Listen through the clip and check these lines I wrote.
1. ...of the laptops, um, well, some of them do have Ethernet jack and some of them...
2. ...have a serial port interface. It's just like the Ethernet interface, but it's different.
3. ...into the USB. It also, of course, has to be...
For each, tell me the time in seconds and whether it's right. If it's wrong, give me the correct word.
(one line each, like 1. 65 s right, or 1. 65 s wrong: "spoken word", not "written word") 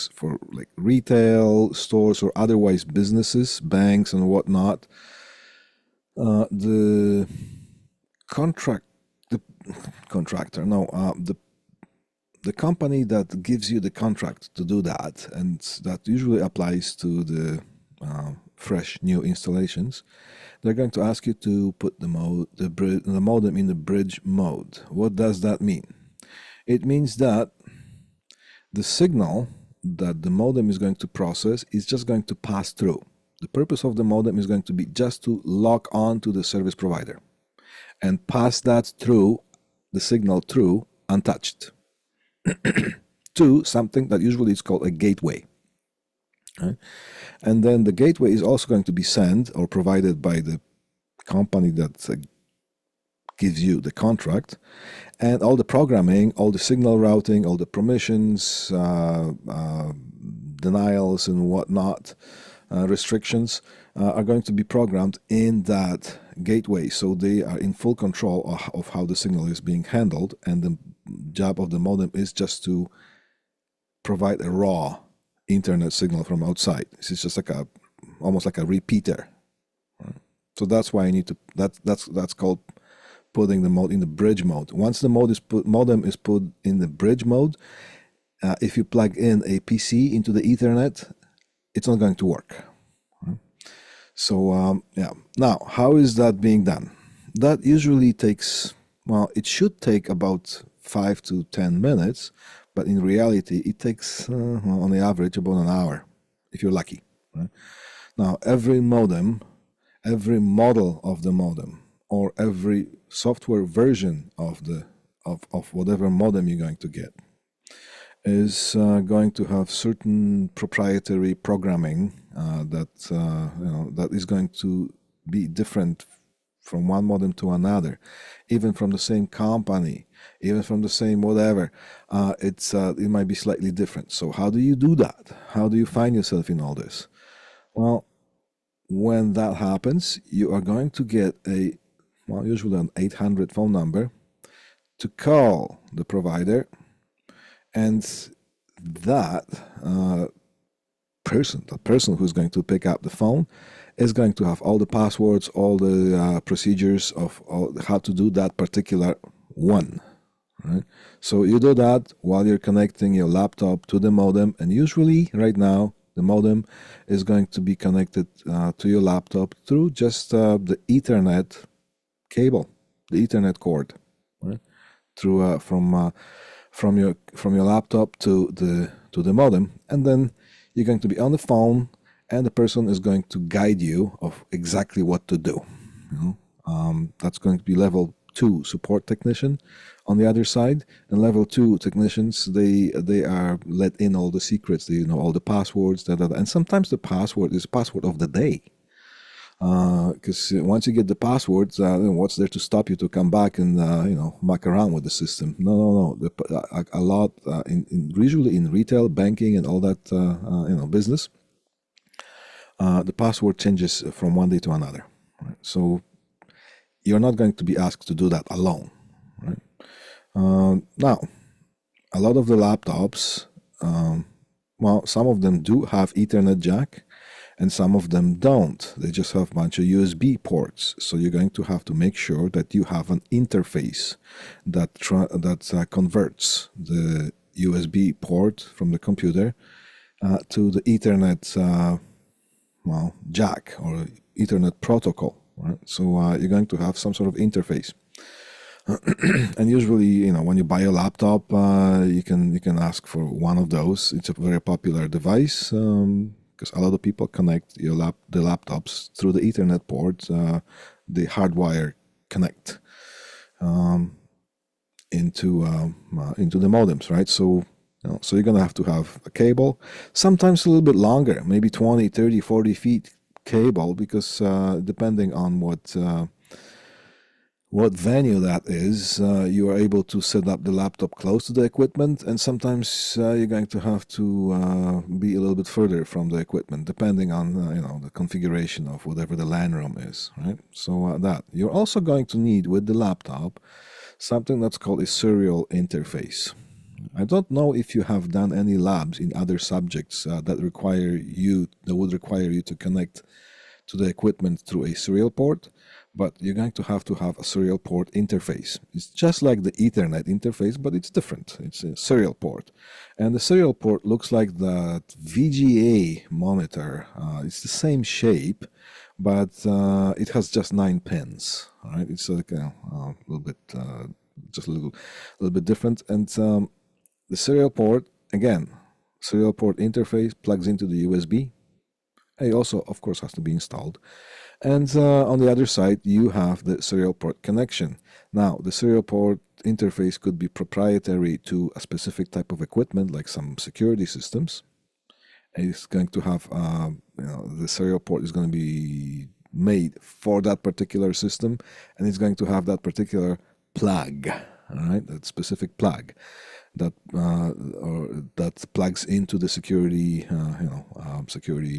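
1. 222 s right
2. 307 s right
3. 330 s right.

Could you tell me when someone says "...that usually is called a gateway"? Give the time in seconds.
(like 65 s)
44 s.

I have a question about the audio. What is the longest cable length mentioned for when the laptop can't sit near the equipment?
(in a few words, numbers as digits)
40 feet.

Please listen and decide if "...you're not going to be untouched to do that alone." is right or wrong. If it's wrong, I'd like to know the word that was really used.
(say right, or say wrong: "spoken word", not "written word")
wrong: "asked", not "untouched".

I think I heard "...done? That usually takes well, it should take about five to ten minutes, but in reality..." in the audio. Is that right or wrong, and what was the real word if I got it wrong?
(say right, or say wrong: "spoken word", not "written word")
right.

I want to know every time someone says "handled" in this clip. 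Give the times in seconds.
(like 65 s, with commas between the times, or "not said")
69 s.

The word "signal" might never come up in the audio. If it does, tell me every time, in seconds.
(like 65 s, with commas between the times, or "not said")
28 s, 39 s, 56 s, 69 s, 75 s.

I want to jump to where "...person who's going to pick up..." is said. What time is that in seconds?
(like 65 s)
151 s.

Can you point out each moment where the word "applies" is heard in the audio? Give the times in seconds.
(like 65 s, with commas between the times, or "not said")
16 s.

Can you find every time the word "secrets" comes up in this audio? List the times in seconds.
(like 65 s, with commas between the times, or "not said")
194 s.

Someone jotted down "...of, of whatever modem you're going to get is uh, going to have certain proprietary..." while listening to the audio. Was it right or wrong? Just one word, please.
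right.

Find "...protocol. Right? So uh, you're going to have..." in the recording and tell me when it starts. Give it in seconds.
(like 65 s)
244 s.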